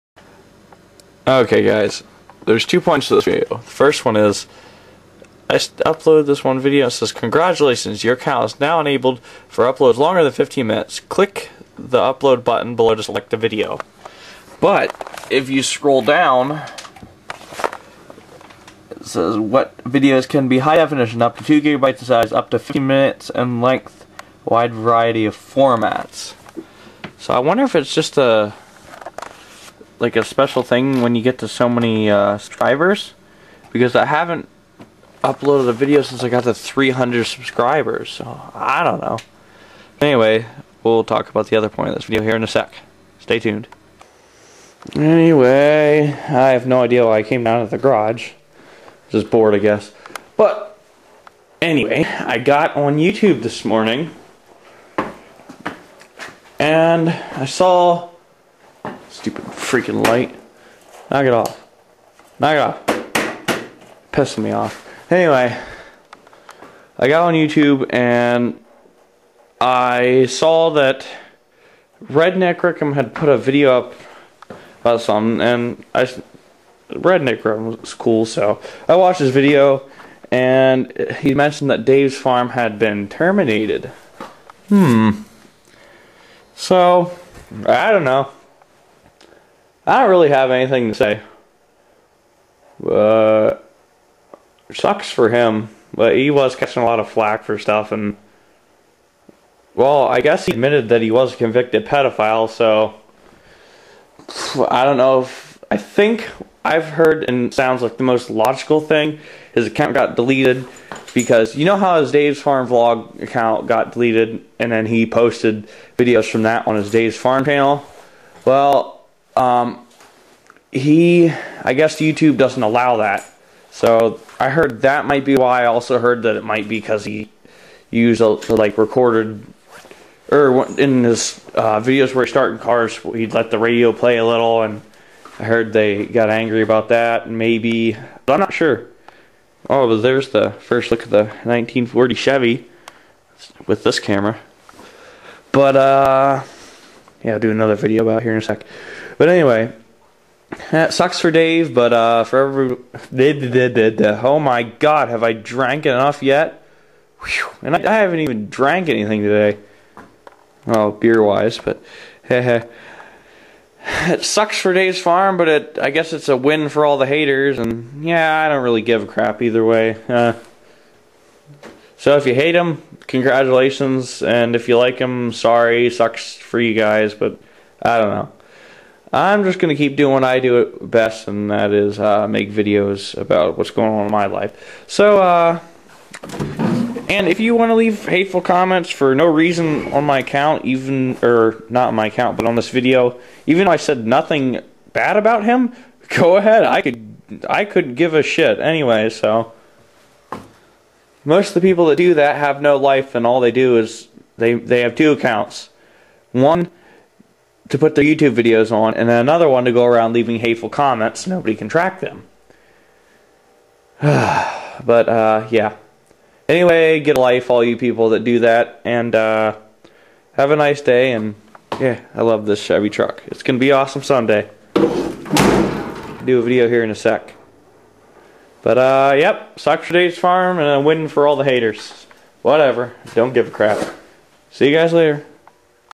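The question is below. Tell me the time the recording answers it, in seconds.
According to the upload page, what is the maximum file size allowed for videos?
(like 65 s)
21 s.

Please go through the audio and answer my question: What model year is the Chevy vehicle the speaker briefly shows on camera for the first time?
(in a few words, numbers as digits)
1940.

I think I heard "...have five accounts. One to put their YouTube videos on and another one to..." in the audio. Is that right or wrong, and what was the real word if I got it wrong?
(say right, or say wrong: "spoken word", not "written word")
wrong: "two", not "five".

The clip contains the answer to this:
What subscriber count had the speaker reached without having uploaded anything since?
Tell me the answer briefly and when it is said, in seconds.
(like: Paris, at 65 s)
300, at 36 s.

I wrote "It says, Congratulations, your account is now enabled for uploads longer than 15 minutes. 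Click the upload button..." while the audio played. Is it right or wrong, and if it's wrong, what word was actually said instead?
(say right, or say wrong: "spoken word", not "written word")
right.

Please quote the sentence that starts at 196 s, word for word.
I could, I could give a shit anyway, so.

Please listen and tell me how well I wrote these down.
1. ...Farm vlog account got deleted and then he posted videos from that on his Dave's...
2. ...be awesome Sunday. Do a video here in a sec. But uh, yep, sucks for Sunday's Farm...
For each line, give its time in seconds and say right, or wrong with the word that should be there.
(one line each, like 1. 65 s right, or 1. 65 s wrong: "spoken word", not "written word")
1. 112 s right
2. 223 s wrong: "Dave", not "Sunday".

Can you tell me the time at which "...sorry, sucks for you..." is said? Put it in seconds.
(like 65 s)
175 s.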